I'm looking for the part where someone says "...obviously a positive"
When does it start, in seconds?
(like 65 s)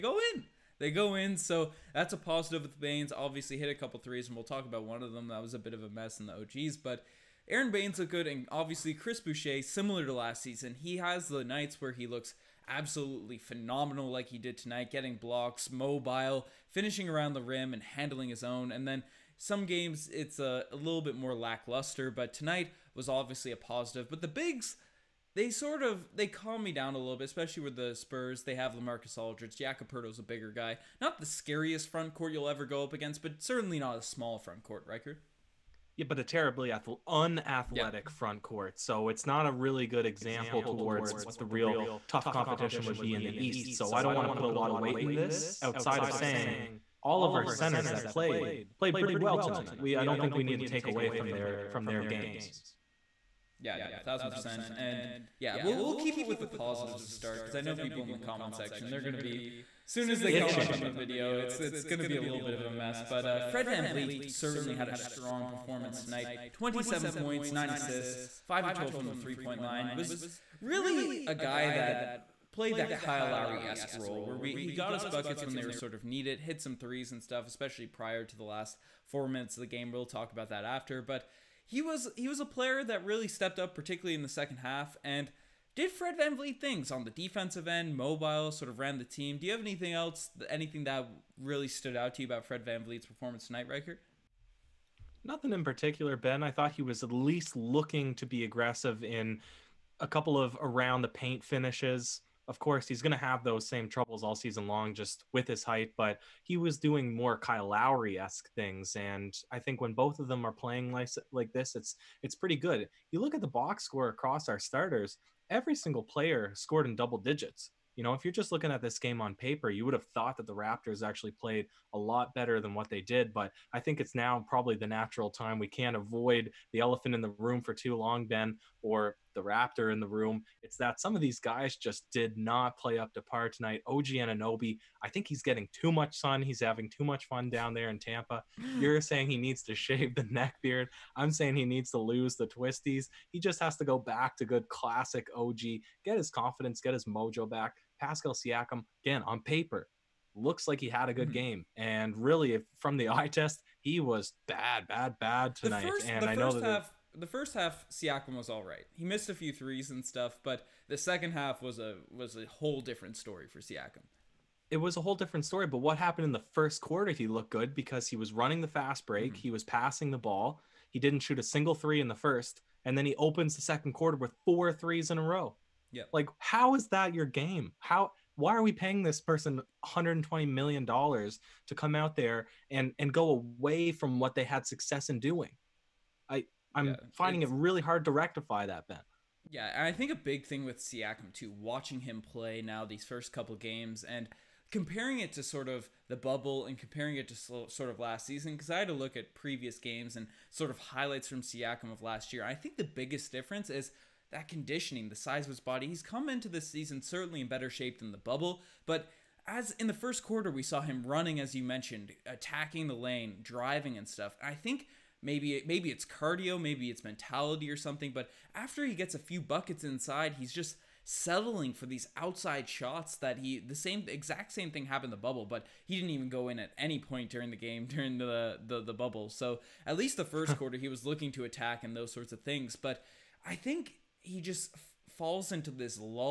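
23 s.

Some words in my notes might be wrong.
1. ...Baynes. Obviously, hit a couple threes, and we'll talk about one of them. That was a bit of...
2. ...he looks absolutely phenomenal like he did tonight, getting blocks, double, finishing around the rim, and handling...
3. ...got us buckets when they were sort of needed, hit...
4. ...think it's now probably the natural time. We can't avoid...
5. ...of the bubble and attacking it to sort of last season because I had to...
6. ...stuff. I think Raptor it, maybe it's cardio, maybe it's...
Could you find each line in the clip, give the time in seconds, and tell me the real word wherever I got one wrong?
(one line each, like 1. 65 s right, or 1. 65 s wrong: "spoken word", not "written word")
1. 2 s right
2. 11 s wrong: "mobile", not "double"
3. 74 s right
4. 123 s right
5. 195 s wrong: "comparing", not "attacking"
6. 214 s wrong: "Maybe", not "Raptor".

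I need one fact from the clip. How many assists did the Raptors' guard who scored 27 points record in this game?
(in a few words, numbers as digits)
9.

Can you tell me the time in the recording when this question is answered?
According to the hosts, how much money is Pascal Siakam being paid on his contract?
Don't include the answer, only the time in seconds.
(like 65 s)
179 s.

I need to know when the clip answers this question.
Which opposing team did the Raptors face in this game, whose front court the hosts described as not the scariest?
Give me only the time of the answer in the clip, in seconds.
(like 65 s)
27 s.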